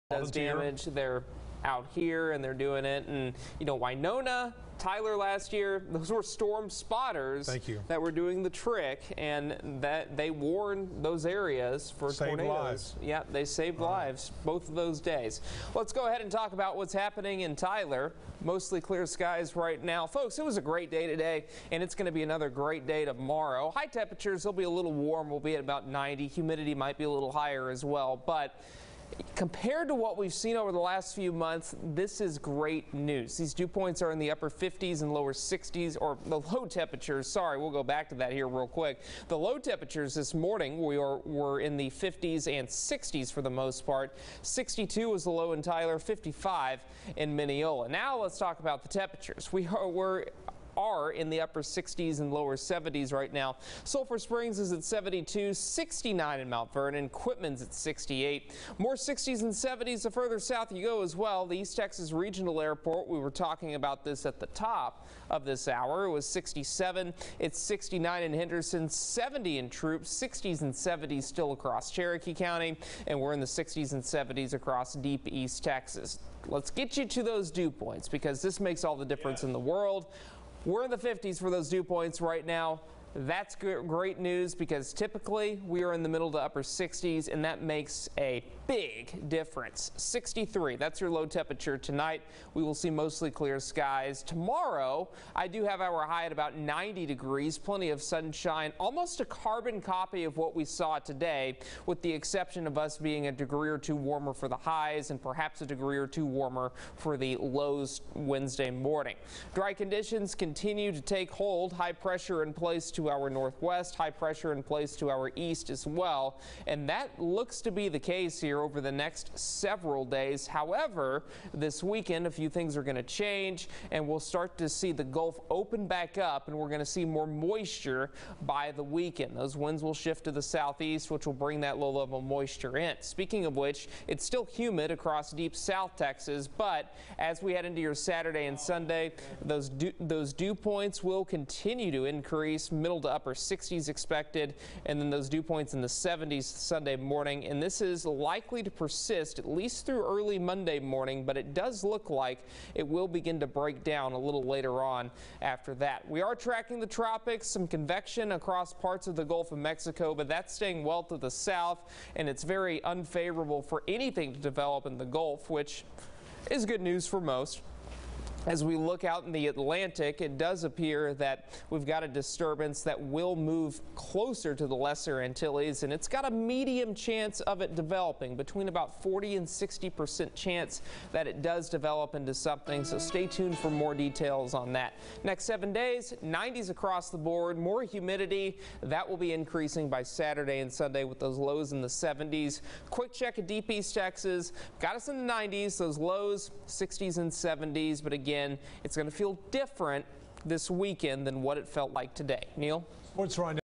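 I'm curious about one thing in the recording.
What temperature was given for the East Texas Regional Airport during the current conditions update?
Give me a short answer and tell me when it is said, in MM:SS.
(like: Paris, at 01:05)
67, at 01:06.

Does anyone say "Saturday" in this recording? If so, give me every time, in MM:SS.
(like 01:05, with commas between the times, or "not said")
02:17, 03:10.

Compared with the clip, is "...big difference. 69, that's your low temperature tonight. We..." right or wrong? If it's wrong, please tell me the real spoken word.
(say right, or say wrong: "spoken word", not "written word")
wrong: "63", not "69".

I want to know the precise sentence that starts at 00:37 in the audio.
Sorry, we'll go back to that here real quick.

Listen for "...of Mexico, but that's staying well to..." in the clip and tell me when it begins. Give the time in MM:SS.
02:39.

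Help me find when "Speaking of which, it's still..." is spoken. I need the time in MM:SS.
02:12.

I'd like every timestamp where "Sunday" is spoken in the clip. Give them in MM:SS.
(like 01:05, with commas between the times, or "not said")
02:18, 02:26, 03:10.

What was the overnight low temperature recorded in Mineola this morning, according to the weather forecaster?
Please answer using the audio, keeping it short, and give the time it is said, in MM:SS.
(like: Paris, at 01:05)
55, at 00:45.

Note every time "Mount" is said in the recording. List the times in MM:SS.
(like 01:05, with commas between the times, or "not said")
00:56.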